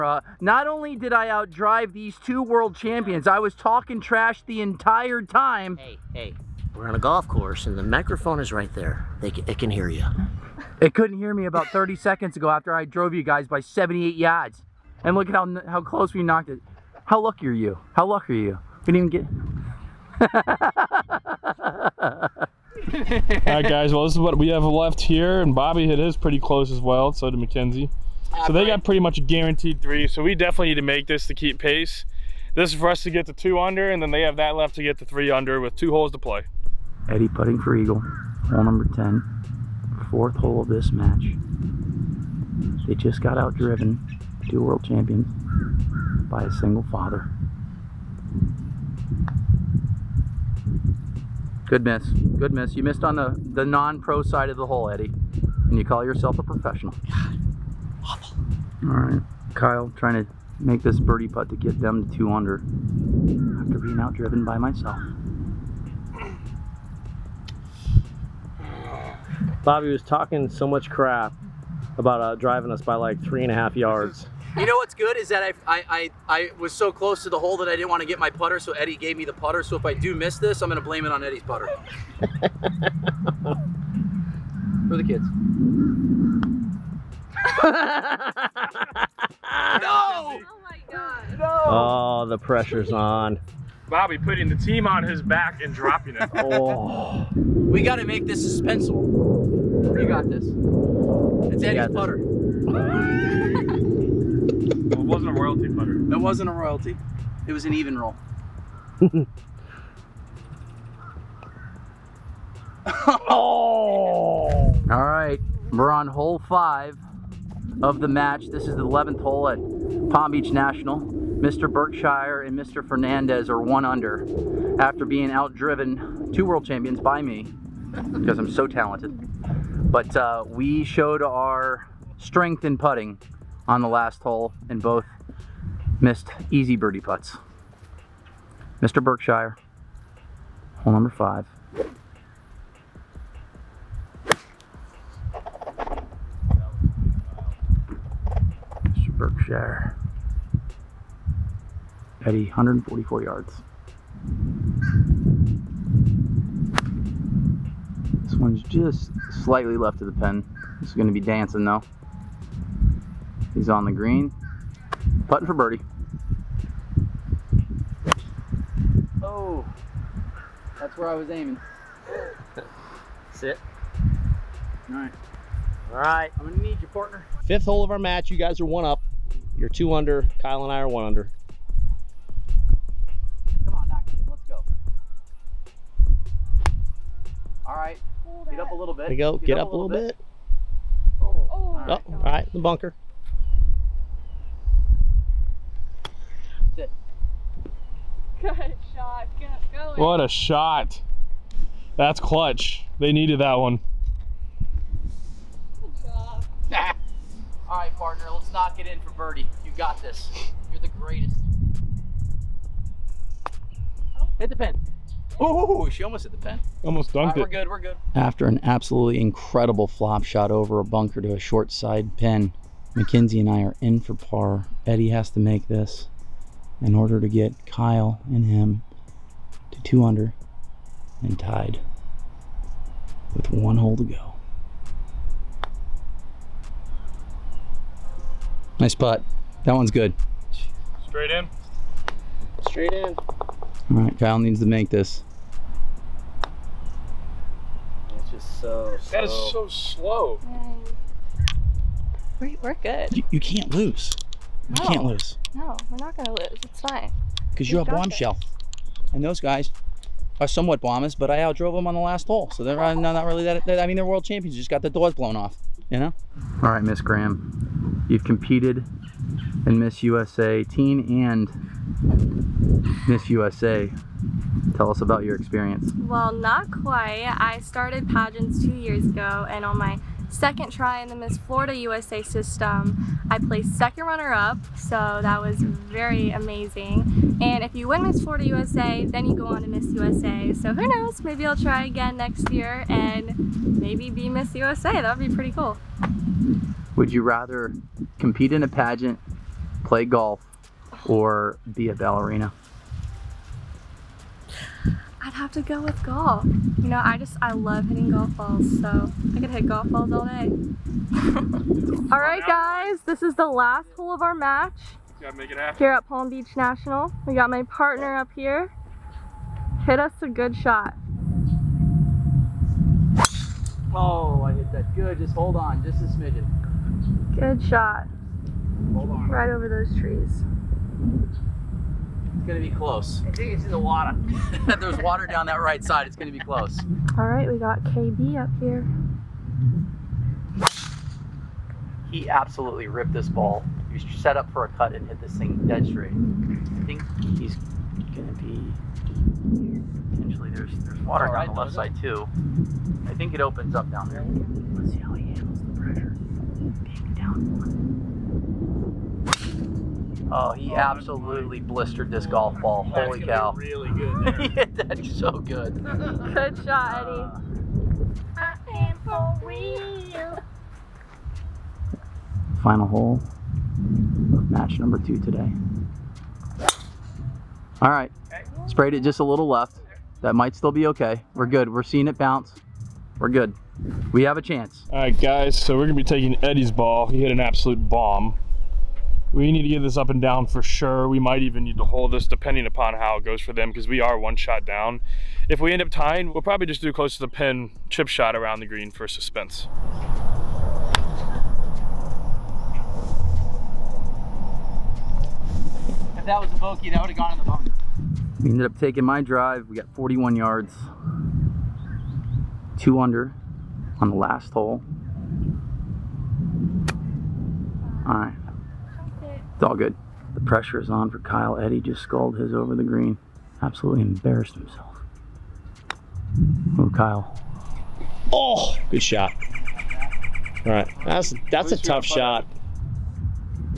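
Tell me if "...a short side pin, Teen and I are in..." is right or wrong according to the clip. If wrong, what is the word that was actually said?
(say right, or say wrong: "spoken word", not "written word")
wrong: "McKenzie", not "Teen".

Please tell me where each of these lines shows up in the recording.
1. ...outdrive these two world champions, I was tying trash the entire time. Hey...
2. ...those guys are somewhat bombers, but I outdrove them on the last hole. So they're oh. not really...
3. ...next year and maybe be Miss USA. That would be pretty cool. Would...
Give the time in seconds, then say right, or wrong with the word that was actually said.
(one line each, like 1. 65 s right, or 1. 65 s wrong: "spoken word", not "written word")
1. 1 s wrong: "talking", not "tying"
2. 259 s right
3. 292 s right.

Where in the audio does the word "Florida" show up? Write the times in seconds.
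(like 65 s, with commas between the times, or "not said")
281 s, 288 s.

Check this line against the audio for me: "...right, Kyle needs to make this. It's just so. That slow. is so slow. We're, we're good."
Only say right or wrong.
right.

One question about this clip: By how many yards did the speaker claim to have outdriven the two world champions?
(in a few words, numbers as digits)
78.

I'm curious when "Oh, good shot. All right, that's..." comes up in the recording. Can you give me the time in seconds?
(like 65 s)
428 s.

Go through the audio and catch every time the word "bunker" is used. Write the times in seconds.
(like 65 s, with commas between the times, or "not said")
192 s, 220 s, 407 s.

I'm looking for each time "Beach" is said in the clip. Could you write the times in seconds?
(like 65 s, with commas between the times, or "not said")
120 s, 316 s.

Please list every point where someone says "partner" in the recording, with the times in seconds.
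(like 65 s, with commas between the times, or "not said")
176 s, 207 s, 317 s.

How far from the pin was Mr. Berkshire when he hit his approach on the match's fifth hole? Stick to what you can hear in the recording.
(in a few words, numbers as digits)
144 yards.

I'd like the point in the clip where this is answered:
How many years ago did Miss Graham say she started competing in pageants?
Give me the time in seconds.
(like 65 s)
278 s.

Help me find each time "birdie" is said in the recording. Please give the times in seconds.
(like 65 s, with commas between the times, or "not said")
61 s, 136 s, 165 s, 209 s.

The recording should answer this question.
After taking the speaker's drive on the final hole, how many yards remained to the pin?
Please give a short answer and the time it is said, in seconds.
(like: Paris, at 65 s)
41, at 409 s.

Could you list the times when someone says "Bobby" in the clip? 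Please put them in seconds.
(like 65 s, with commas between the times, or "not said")
25 s, 69 s, 93 s.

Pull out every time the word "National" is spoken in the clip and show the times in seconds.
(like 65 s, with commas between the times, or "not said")
120 s, 316 s.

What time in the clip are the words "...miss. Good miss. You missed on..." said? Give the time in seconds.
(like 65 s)
51 s.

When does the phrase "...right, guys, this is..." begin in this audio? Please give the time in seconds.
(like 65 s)
312 s.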